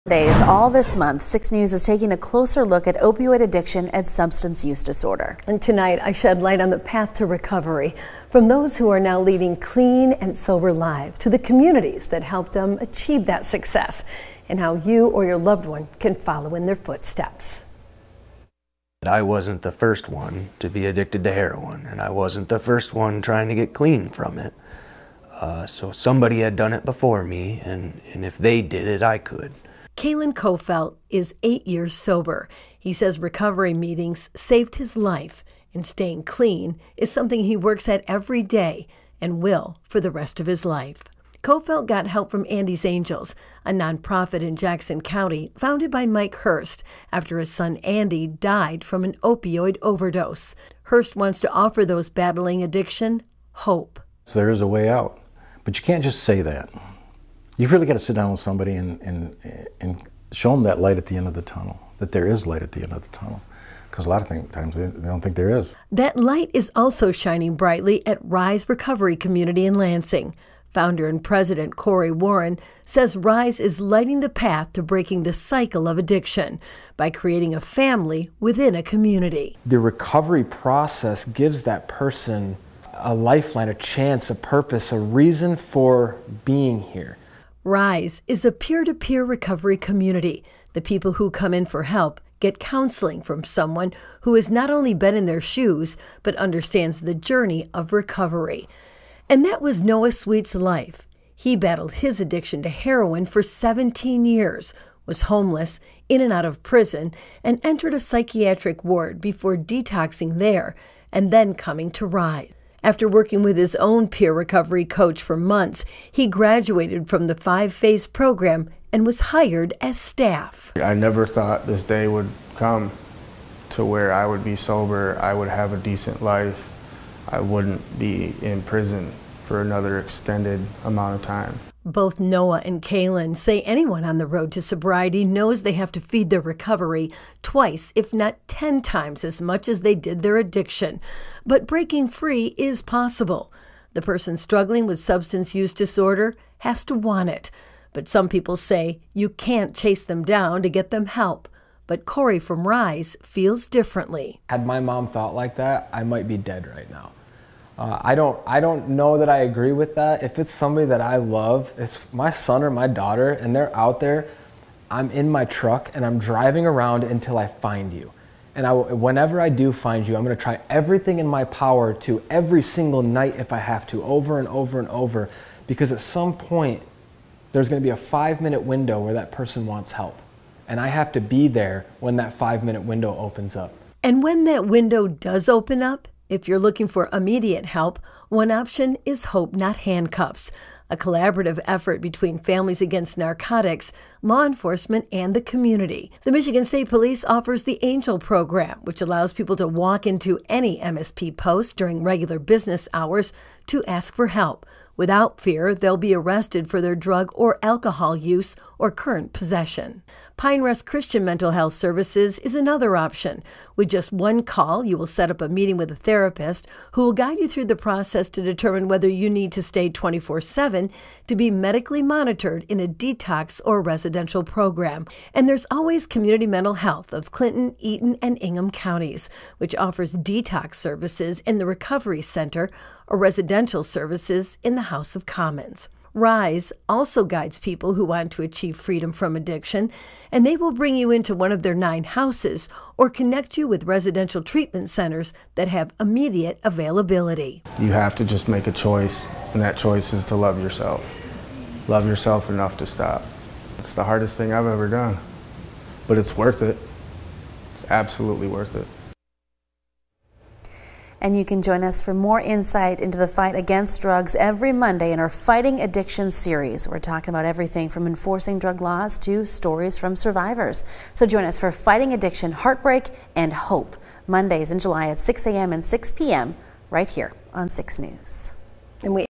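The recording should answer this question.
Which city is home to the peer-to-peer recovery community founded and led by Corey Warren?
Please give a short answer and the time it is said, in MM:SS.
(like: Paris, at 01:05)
Lansing, at 01:09.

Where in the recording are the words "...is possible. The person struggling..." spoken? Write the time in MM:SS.
02:22.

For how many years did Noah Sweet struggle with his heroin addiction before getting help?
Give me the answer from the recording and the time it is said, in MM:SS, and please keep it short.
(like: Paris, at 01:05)
17, at 01:43.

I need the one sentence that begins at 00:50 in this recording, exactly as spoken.
Hurst wants to offer those battling addiction hope.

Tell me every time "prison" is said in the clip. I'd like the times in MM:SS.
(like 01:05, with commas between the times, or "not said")
01:46, 02:08.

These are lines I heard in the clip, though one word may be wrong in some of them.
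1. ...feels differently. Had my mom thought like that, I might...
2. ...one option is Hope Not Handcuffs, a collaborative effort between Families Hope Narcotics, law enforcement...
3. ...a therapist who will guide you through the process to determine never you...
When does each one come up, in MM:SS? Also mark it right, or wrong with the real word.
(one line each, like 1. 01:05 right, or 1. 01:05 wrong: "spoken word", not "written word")
1. 02:33 right
2. 03:08 wrong: "Against", not "Hope"
3. 03:35 wrong: "whether", not "never".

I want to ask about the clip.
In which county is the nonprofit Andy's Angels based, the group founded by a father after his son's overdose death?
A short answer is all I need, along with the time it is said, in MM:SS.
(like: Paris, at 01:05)
Jackson County, at 00:44.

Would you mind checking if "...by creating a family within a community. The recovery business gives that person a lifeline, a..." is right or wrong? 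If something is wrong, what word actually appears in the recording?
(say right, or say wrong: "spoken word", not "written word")
wrong: "process", not "business".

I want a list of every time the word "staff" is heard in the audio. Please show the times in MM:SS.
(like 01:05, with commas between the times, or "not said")
01:59.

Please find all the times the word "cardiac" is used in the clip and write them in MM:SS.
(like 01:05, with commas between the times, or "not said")
not said.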